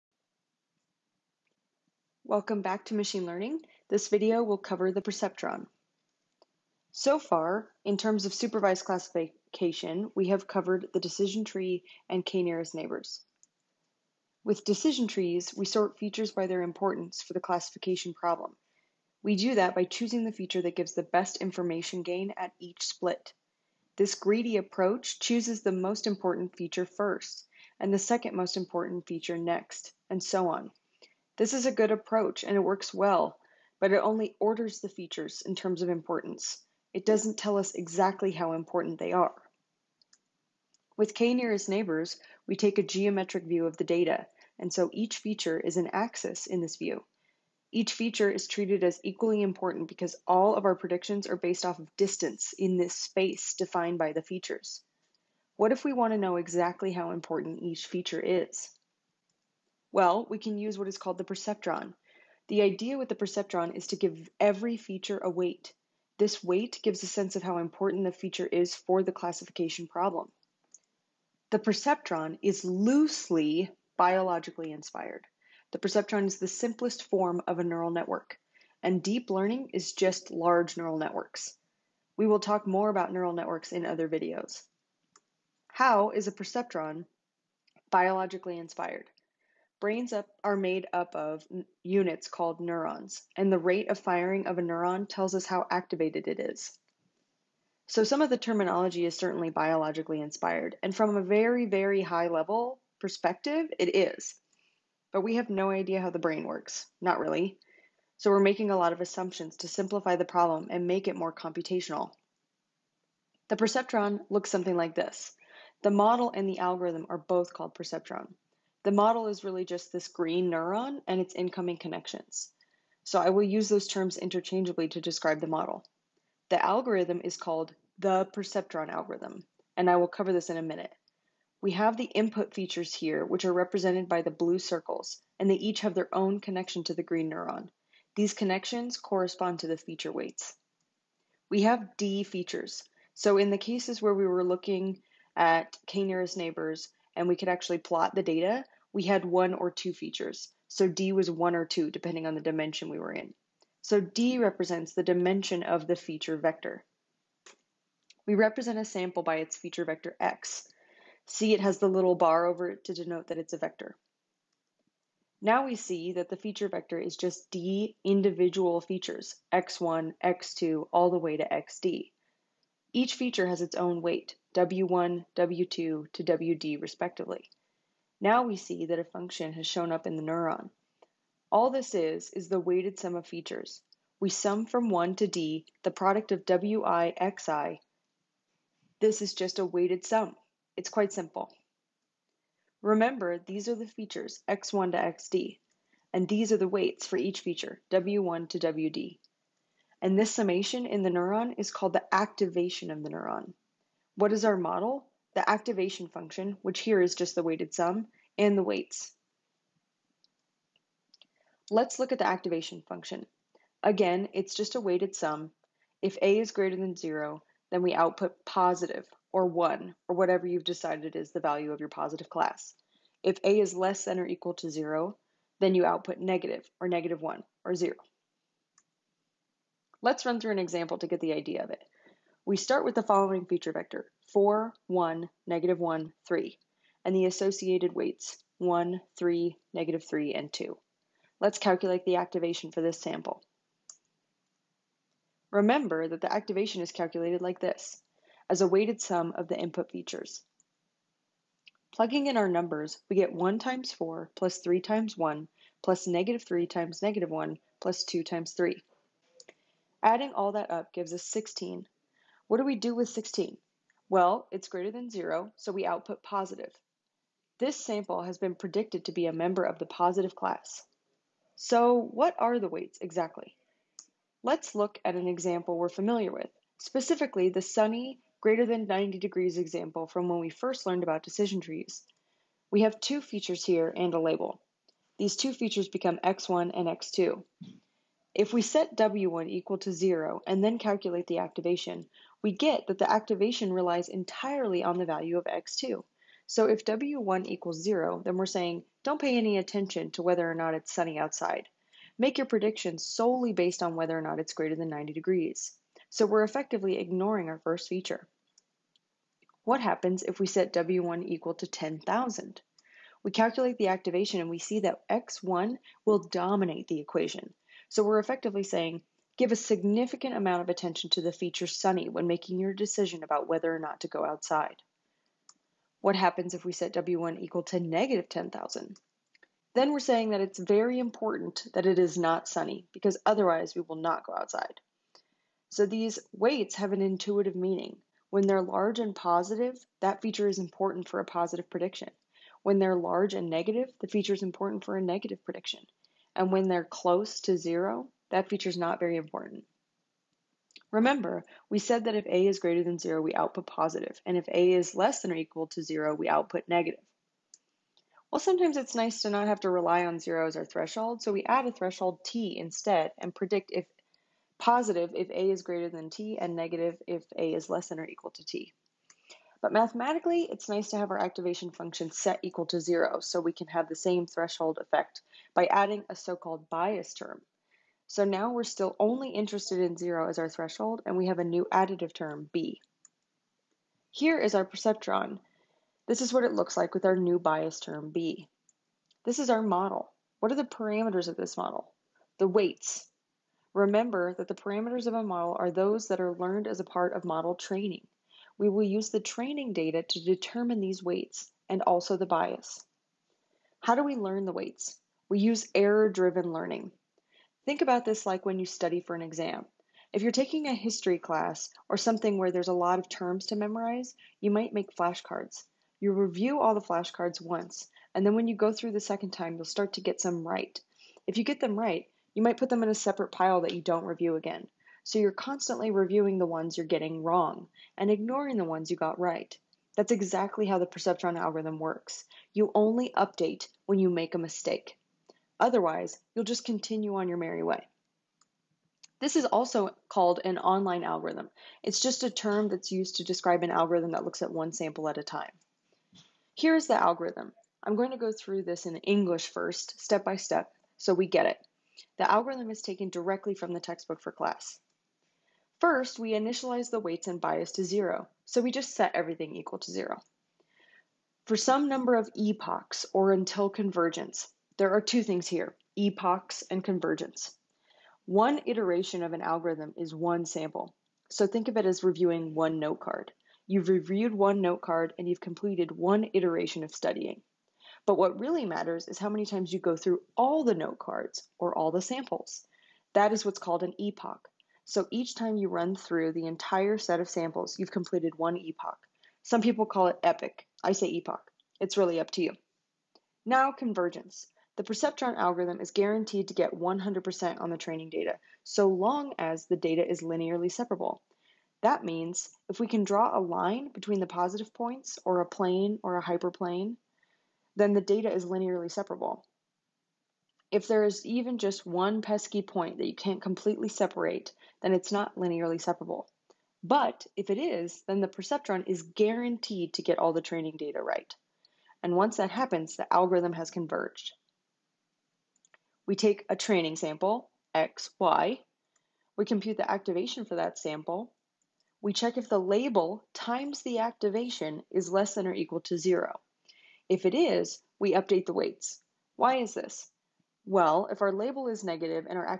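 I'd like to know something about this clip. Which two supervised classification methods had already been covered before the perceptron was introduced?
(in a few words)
decision tree and k-nearest neighbors.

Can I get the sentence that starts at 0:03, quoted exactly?
This video will cover the perceptron.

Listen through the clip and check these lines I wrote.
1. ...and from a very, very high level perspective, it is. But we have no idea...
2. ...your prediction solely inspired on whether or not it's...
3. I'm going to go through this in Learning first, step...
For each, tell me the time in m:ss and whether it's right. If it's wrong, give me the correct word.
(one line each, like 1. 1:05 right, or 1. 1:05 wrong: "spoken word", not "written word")
1. 1:40 right
2. 5:02 wrong: "based", not "inspired"
3. 7:27 wrong: "English", not "Learning".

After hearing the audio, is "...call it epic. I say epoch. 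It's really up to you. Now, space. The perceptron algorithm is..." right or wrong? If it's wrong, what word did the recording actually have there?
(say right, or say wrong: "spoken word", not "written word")
wrong: "convergence", not "space".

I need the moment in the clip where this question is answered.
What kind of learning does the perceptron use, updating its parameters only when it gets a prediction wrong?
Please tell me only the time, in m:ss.
6:45.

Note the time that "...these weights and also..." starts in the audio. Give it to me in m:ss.
6:40.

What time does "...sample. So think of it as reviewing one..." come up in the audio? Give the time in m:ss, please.
7:50.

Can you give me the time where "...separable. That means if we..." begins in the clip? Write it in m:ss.
8:20.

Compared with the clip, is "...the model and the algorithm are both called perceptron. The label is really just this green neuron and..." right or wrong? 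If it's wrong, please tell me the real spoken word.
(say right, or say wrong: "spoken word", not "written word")
wrong: "model", not "label".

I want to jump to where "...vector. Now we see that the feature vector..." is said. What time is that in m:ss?
2:43.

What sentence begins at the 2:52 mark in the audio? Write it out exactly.
Each feature has its own weight, w1, w2 to wd respectively.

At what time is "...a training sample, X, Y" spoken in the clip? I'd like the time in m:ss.
8:46.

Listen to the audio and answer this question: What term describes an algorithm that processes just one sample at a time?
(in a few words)
online algorithm.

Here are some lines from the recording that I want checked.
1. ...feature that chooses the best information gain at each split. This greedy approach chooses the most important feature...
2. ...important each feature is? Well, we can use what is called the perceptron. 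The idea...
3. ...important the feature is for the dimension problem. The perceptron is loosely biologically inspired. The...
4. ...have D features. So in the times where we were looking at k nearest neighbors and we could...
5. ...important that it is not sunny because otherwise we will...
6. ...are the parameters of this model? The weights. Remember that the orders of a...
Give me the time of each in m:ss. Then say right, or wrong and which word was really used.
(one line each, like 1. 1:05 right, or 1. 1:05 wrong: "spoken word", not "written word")
1. 0:20 wrong: "gives", not "chooses"
2. 0:57 right
3. 1:07 wrong: "classification", not "dimension"
4. 2:21 wrong: "cases", not "times"
5. 5:30 right
6. 6:30 wrong: "parameters", not "orders".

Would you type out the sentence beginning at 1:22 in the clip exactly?
We will talk more about neural networks in other videos.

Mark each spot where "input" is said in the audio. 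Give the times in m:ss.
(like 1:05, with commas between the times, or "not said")
2:12, 4:09.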